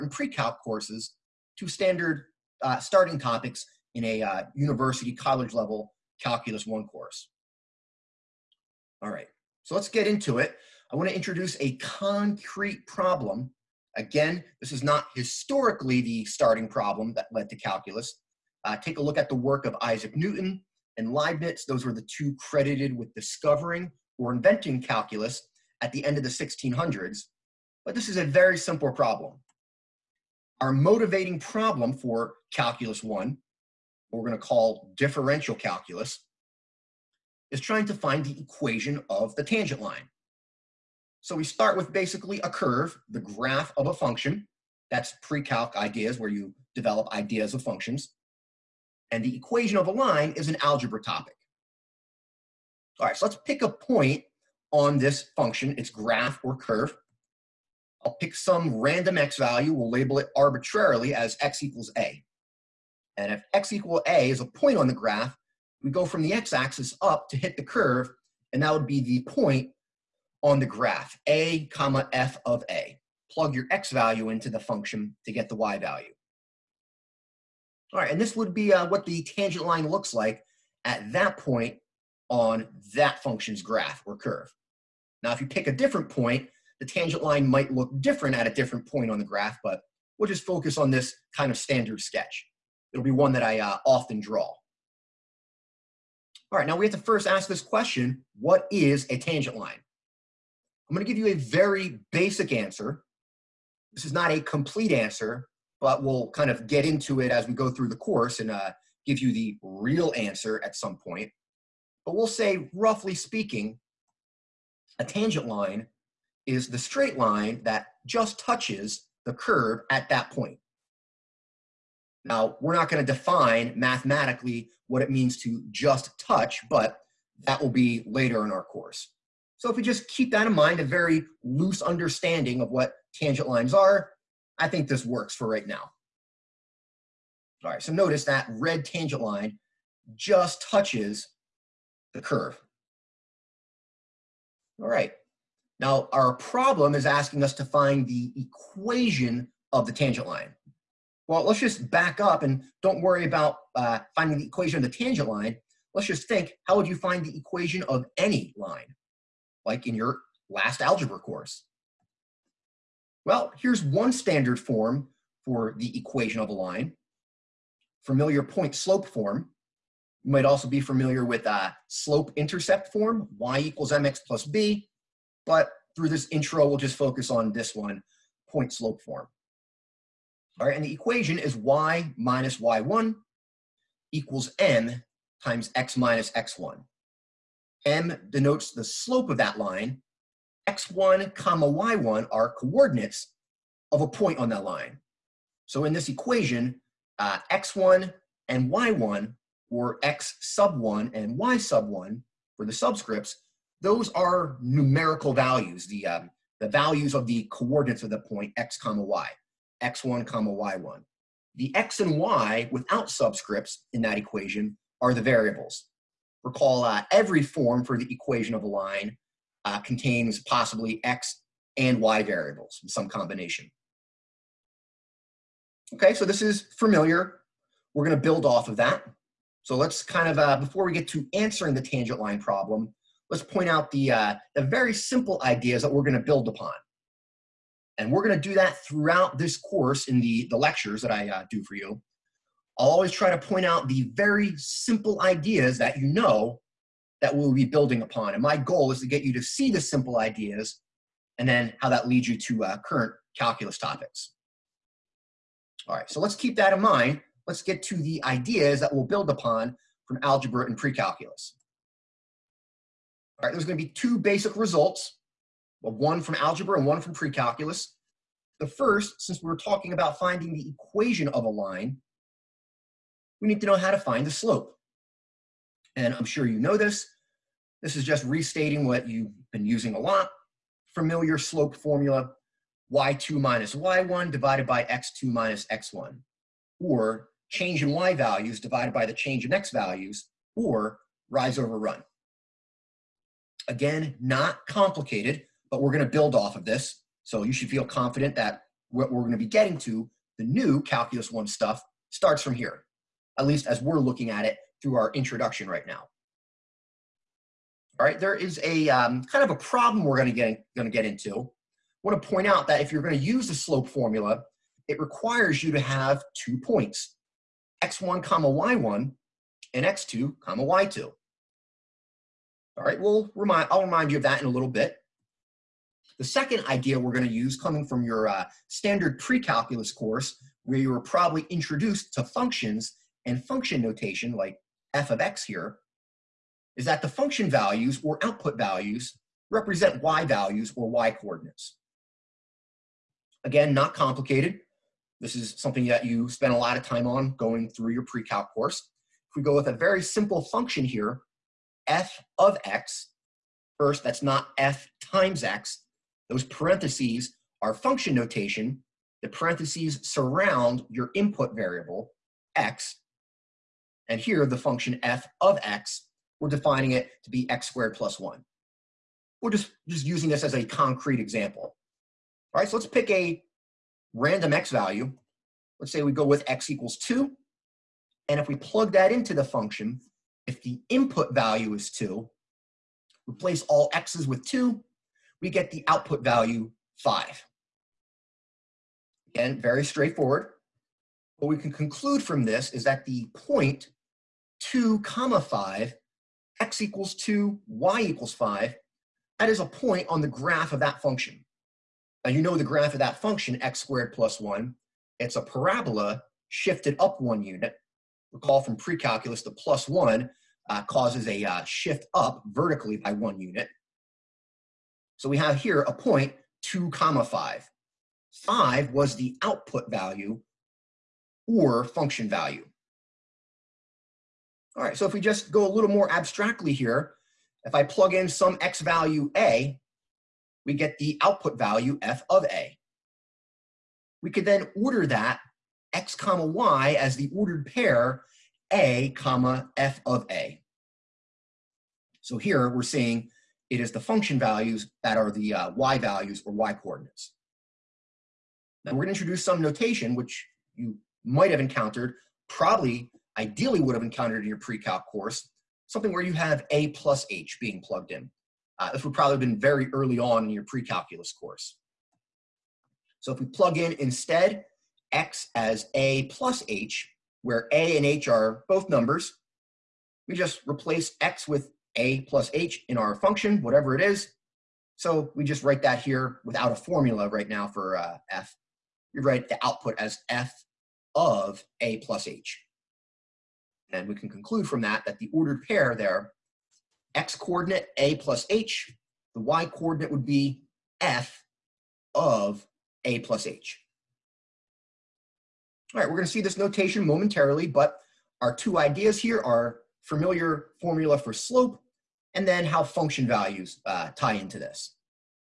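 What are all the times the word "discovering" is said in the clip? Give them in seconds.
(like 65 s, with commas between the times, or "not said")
23 s.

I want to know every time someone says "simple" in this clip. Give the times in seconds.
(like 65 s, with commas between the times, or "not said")
28 s, 234 s, 244 s, 249 s, 350 s.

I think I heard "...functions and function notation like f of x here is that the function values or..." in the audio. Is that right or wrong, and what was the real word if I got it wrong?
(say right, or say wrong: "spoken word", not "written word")
right.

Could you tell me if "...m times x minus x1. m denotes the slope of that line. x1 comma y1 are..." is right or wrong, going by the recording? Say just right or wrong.
right.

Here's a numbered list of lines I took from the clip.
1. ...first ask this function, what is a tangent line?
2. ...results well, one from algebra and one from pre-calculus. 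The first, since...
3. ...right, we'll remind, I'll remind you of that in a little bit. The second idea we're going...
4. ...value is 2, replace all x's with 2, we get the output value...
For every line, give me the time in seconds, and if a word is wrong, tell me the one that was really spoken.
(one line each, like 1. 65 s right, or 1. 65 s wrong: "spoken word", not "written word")
1. 97 s wrong: "question", not "function"
2. 264 s right
3. 322 s right
4. 381 s right.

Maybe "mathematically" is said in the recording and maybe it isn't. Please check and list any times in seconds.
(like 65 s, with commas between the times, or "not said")
123 s.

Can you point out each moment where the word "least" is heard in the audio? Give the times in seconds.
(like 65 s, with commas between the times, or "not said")
303 s.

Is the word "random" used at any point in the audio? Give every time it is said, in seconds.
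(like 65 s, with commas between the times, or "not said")
58 s, 374 s.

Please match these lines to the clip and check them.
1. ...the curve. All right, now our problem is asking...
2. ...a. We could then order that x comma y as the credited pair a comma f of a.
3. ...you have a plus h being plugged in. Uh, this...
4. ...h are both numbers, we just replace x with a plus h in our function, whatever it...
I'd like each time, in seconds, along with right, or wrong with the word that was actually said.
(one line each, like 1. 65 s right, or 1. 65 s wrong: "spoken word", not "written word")
1. 142 s right
2. 432 s wrong: "ordered", not "credited"
3. 456 s right
4. 468 s right.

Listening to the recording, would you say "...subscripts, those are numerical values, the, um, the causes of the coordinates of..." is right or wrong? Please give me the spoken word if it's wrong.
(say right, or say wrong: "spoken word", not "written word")
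wrong: "values", not "causes".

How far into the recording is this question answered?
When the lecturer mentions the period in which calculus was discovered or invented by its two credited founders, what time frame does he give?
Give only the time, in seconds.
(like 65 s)
26 s.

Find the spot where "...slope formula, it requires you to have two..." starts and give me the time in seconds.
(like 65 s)
313 s.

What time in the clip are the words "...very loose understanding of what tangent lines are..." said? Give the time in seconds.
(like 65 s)
130 s.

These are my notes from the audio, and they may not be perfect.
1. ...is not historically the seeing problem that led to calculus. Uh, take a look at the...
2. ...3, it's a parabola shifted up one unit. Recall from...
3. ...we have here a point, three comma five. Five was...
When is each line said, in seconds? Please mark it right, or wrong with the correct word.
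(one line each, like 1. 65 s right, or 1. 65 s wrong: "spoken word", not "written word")
1. 14 s wrong: "starting", not "seeing"
2. 404 s wrong: "1", not "3"
3. 415 s wrong: "two", not "three".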